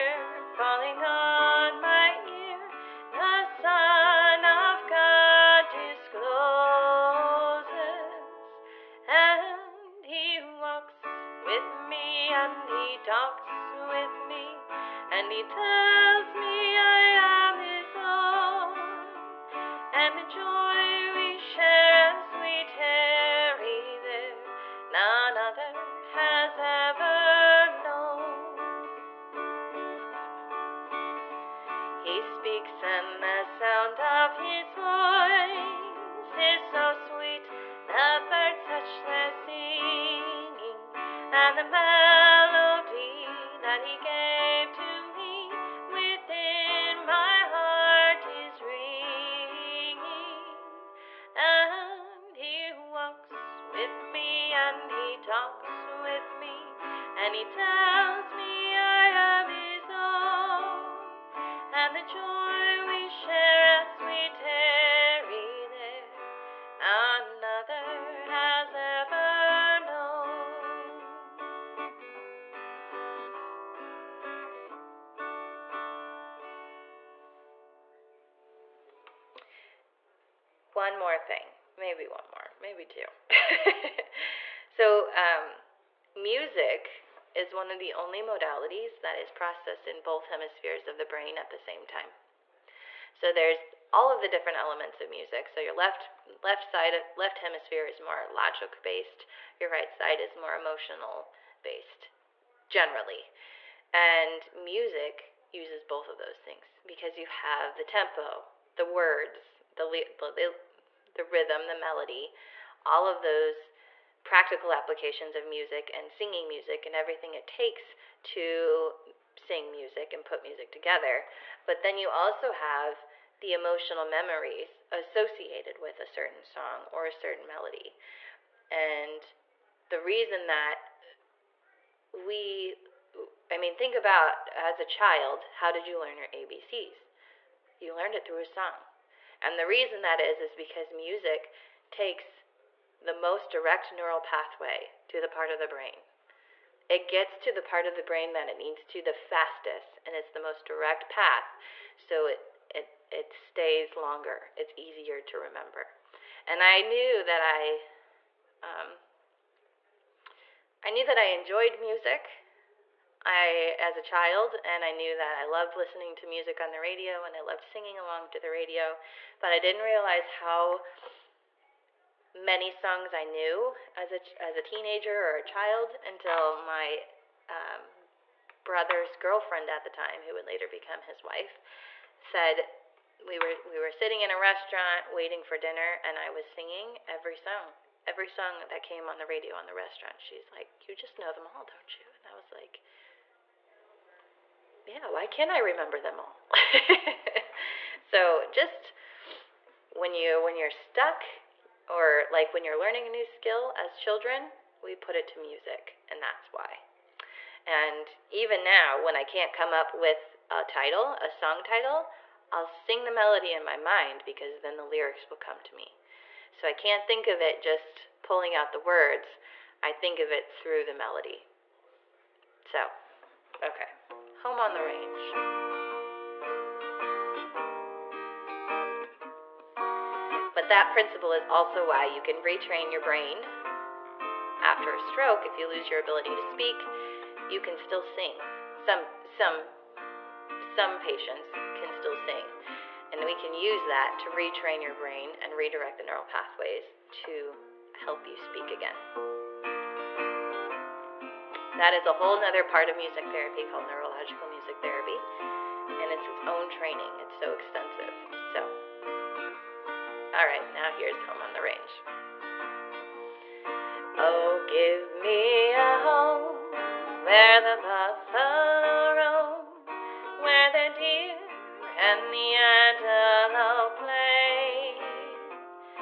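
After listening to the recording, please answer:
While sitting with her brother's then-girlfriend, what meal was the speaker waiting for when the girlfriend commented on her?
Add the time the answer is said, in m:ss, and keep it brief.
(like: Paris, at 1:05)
dinner, at 3:05.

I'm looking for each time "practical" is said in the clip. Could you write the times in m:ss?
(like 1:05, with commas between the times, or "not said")
1:54.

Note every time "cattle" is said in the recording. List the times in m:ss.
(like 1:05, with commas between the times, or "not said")
not said.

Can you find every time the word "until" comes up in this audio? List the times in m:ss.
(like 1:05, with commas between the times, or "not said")
2:56.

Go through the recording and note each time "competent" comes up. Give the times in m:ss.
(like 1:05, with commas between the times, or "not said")
not said.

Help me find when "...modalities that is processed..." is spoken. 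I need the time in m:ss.
1:28.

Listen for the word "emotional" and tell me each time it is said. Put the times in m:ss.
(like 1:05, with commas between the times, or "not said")
1:40, 2:03.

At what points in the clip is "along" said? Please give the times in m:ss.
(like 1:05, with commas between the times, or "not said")
2:47.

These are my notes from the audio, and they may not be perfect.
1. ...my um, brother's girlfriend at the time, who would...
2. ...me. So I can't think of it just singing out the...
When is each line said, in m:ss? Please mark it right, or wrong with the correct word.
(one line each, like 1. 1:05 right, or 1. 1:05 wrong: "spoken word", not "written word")
1. 2:56 right
2. 3:35 wrong: "pulling", not "singing".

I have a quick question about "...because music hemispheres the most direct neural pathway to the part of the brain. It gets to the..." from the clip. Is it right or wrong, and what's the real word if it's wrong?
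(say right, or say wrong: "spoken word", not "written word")
wrong: "takes", not "hemispheres".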